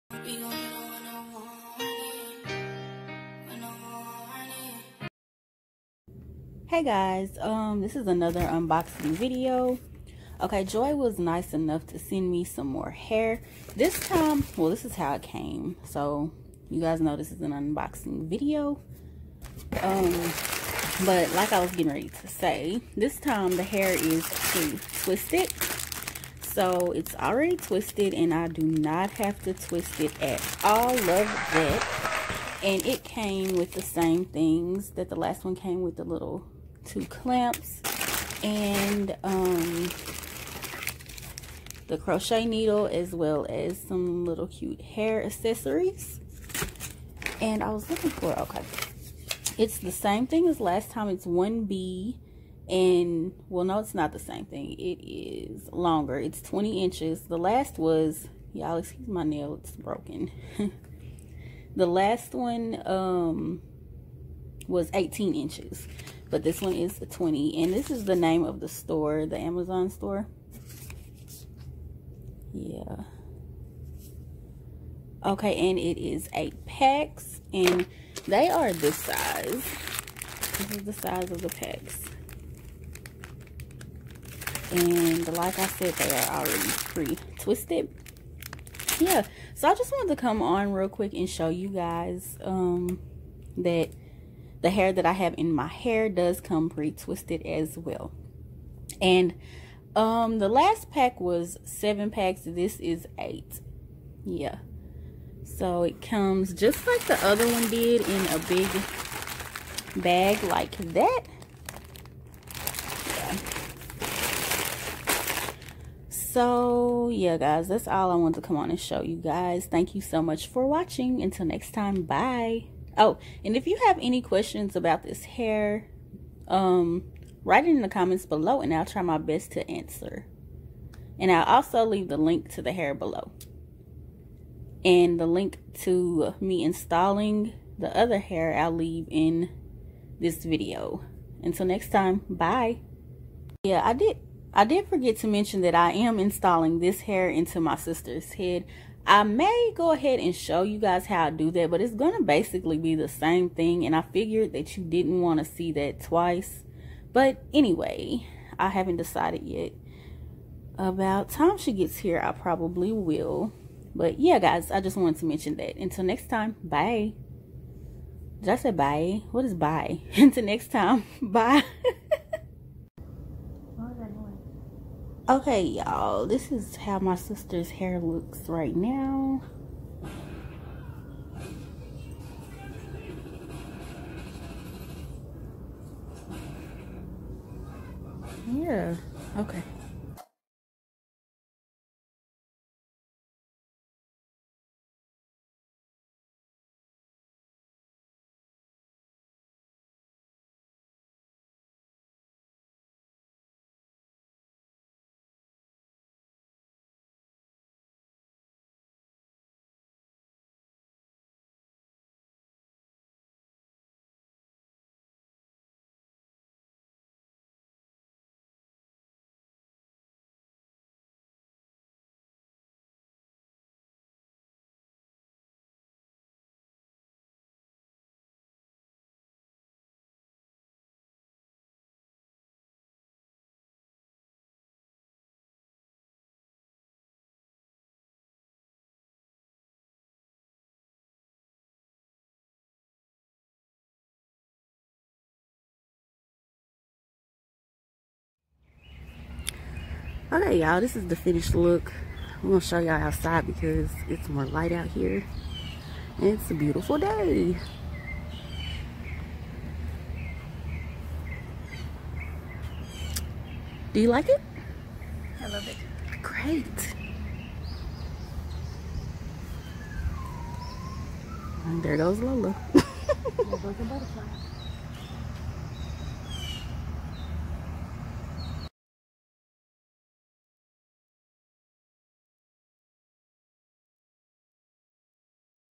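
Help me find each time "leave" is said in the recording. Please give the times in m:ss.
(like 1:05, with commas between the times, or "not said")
2:11, 2:18.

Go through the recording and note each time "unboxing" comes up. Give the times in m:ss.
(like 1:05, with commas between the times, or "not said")
0:08, 0:17.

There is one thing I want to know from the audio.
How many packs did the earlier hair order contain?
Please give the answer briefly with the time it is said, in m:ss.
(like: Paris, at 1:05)
7, at 1:41.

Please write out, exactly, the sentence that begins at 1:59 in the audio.
Thank you so much for watching.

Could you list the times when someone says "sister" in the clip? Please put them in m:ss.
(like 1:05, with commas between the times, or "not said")
2:27, 2:57.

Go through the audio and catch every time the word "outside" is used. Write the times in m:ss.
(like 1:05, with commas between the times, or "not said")
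4:12.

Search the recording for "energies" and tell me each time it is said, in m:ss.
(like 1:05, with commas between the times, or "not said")
not said.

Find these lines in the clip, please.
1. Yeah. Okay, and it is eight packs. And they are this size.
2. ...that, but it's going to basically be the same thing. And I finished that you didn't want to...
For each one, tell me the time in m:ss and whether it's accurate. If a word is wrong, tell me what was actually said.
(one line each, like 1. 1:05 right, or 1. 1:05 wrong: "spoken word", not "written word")
1. 1:12 right
2. 2:31 wrong: "figured", not "finished".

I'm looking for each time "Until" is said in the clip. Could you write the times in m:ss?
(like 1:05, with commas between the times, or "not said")
2:01, 2:21, 2:45, 2:50.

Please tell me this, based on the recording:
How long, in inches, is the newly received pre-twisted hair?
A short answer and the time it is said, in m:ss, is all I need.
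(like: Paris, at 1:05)
20 inches, at 0:56.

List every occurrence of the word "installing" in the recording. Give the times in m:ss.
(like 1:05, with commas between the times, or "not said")
2:16, 2:26.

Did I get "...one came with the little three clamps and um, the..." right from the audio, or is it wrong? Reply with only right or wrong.
wrong.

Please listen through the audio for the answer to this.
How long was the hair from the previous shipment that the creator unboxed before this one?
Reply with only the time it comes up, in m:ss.
1:04.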